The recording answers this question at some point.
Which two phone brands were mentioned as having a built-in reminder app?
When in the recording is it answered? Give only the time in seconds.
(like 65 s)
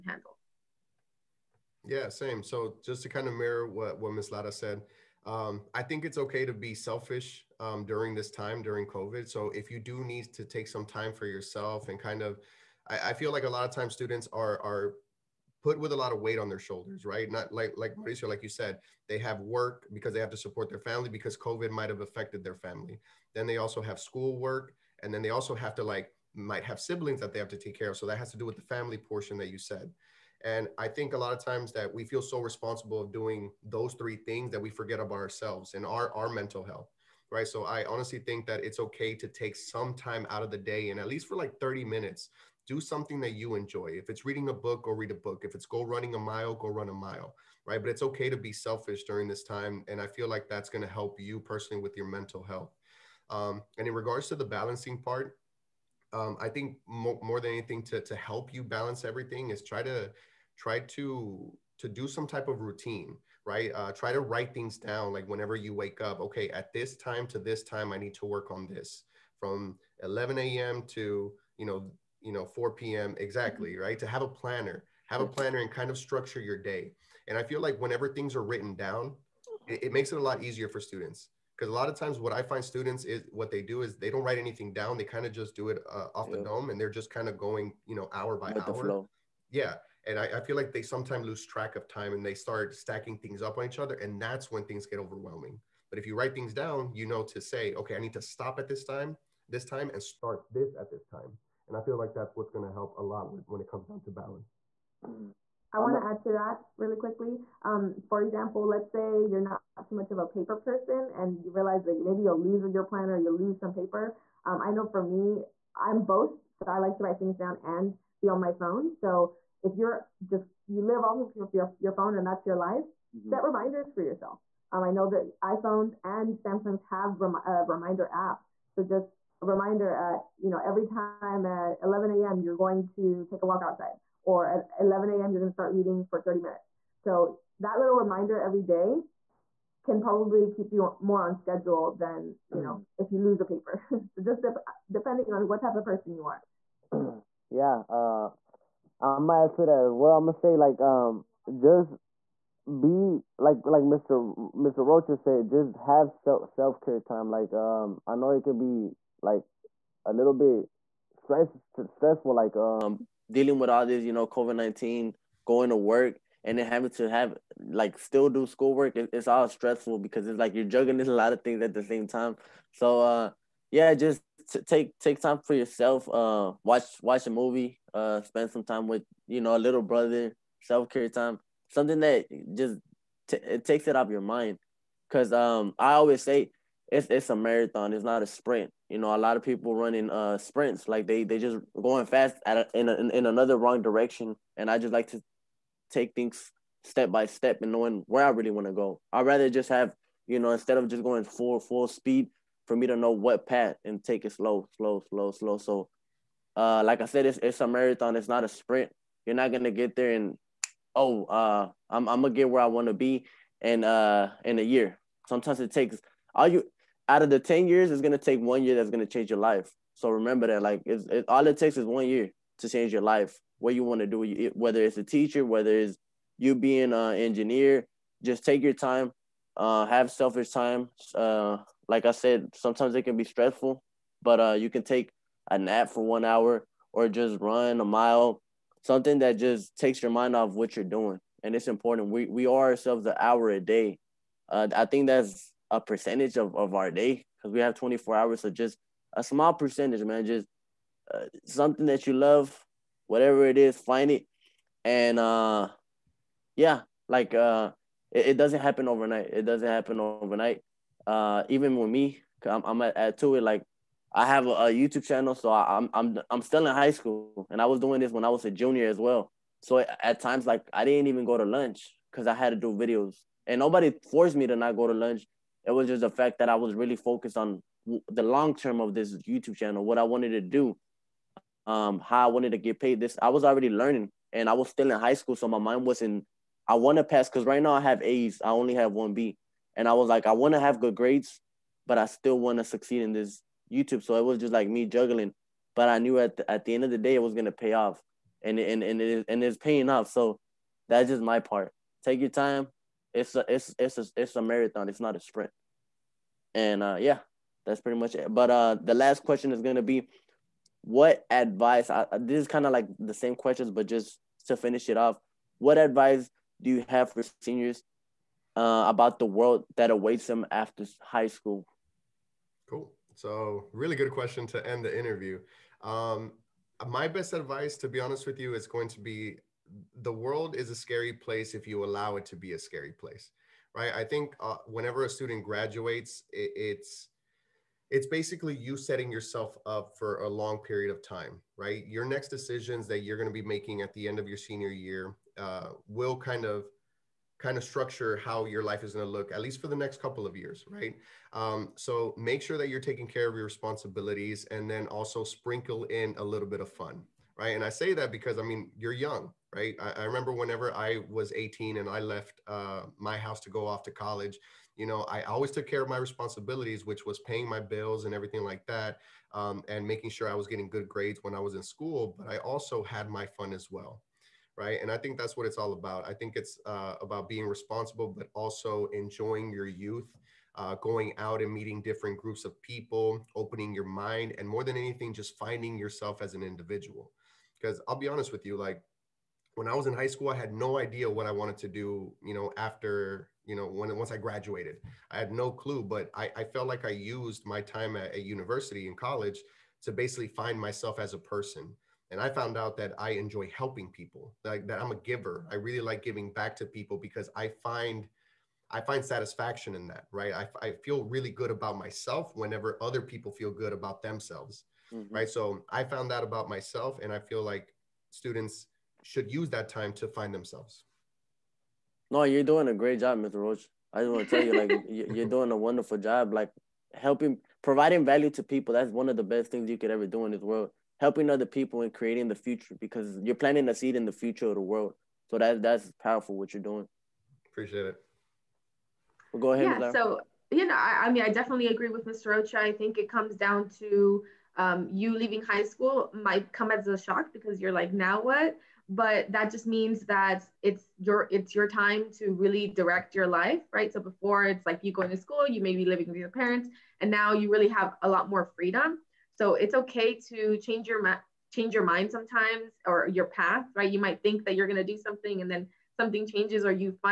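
125 s.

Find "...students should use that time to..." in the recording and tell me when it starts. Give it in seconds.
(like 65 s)
418 s.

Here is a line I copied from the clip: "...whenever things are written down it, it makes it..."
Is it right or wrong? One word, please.
right.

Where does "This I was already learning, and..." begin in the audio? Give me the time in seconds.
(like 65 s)
283 s.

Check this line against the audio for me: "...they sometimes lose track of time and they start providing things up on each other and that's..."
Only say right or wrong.
wrong.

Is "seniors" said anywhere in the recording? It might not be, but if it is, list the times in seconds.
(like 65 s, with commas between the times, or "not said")
317 s, 344 s.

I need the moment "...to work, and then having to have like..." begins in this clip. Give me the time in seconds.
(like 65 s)
165 s.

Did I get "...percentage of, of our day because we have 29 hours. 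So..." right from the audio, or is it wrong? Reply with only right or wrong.
wrong.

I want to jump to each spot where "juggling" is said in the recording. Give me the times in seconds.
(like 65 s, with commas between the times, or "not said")
170 s, 294 s.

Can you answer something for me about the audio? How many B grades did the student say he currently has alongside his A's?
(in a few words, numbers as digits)
1.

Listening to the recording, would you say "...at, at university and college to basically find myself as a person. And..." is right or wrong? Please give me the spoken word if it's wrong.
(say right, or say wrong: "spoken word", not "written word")
right.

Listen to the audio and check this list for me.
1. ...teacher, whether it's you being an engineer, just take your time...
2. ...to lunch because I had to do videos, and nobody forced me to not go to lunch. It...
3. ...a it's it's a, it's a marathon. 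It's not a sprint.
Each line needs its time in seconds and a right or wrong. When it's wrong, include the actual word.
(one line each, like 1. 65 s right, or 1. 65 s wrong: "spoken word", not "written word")
1. 225 s right
2. 271 s right
3. 303 s right.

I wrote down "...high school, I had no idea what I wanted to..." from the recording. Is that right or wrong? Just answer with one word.
right.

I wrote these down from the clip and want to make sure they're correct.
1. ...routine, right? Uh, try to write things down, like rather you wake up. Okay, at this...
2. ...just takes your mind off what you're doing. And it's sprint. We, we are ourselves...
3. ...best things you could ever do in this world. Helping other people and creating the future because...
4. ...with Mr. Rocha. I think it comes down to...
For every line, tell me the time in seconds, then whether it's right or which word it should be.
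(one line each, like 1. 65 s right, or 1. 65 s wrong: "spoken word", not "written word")
1. 62 s wrong: "whenever", not "rather"
2. 239 s wrong: "important", not "sprint"
3. 429 s right
4. 441 s right.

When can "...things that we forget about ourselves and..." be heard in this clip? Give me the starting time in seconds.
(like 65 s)
34 s.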